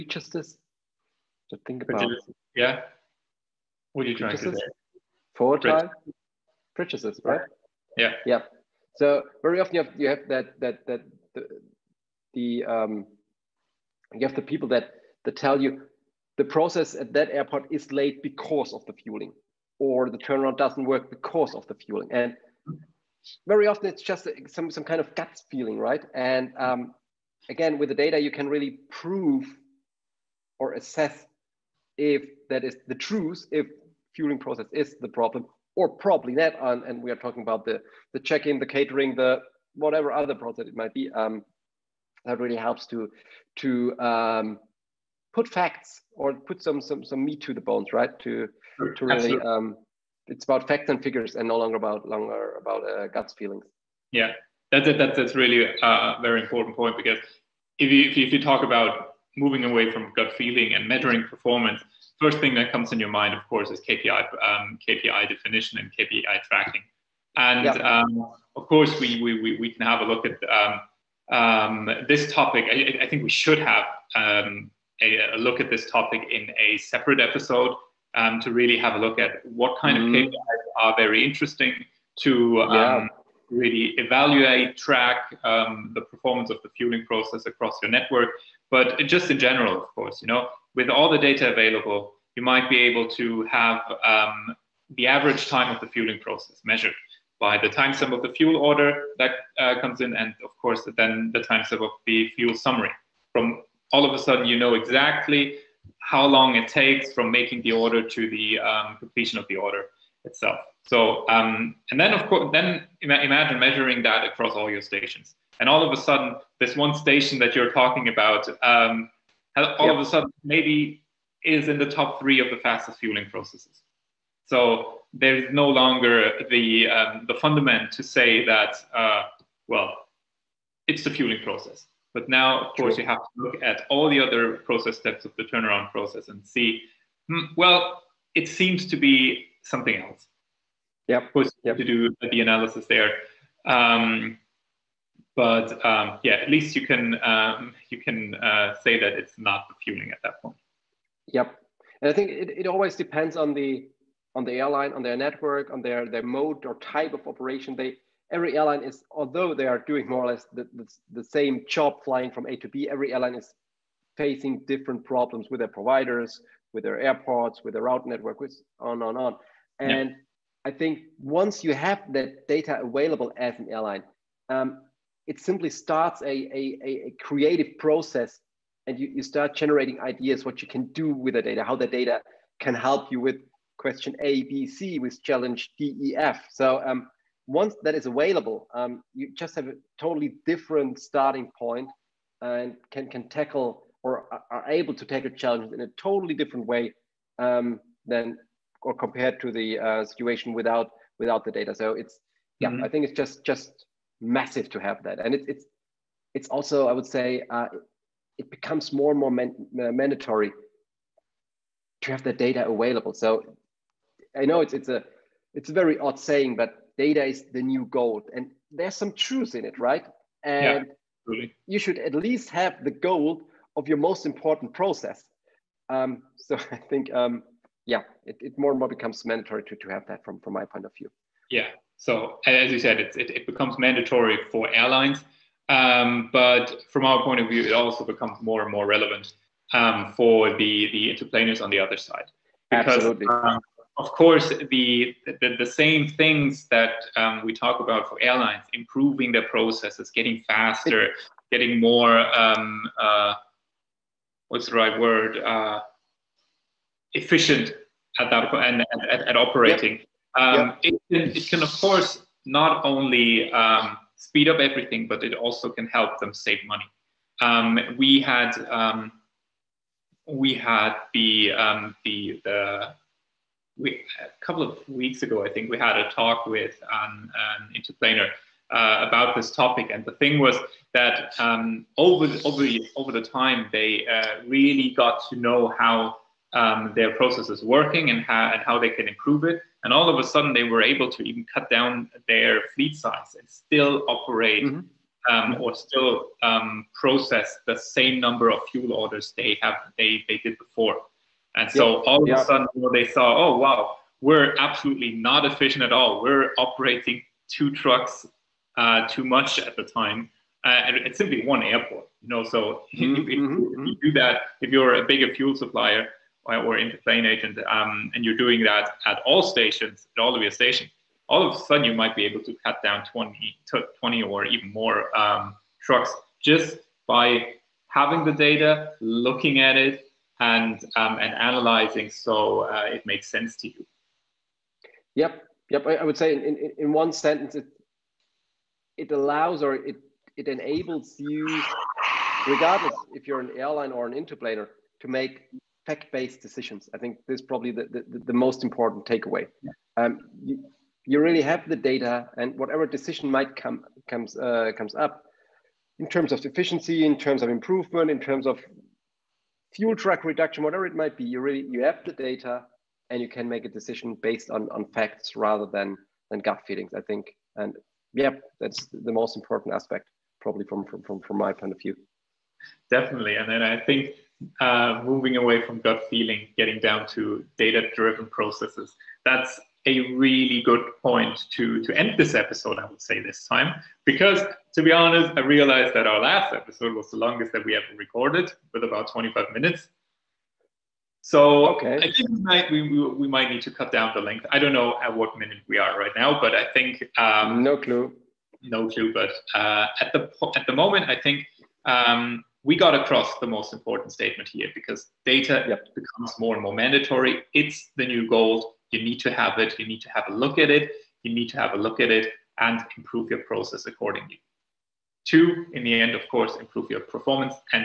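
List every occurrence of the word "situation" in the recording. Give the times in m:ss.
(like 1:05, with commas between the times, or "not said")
3:20.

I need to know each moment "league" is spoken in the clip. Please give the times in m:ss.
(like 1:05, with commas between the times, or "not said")
not said.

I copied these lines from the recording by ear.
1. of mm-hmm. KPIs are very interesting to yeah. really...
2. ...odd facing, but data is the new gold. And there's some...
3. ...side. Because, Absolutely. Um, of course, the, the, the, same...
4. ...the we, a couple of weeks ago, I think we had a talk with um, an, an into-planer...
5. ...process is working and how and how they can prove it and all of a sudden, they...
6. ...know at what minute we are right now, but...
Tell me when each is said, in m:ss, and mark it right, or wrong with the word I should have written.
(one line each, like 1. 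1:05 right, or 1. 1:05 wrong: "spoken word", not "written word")
1. 1:20 right
2. 3:35 wrong: "saying", not "facing"
3. 4:01 right
4. 4:32 right
5. 4:47 wrong: "improve", not "prove"
6. 6:34 right.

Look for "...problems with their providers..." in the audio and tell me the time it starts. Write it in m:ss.
2:45.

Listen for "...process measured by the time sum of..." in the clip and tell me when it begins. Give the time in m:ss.
1:36.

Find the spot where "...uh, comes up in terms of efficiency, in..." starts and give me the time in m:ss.
5:54.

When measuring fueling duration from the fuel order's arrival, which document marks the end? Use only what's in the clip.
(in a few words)
fuel summary.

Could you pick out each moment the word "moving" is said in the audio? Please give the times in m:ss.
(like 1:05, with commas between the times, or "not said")
0:59, 6:15.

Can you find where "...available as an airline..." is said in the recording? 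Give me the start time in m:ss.
2:52.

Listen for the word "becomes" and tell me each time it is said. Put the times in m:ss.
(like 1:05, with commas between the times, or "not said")
3:28, 3:48, 3:53, 3:58, 6:45.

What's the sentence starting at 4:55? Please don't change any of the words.
Um, or still um, process the same number of fuel orders they have they, they did before.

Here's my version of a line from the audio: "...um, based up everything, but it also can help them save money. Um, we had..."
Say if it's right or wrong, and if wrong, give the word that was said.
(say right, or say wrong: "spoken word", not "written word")
wrong: "speed", not "based".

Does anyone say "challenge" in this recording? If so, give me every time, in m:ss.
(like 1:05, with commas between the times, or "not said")
3:05, 3:15.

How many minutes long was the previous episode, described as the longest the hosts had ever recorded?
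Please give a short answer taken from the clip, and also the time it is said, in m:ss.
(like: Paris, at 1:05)
25, at 6:29.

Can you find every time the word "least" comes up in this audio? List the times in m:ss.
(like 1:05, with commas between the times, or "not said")
2:26, 3:42.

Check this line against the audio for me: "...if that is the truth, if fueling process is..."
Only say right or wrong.
right.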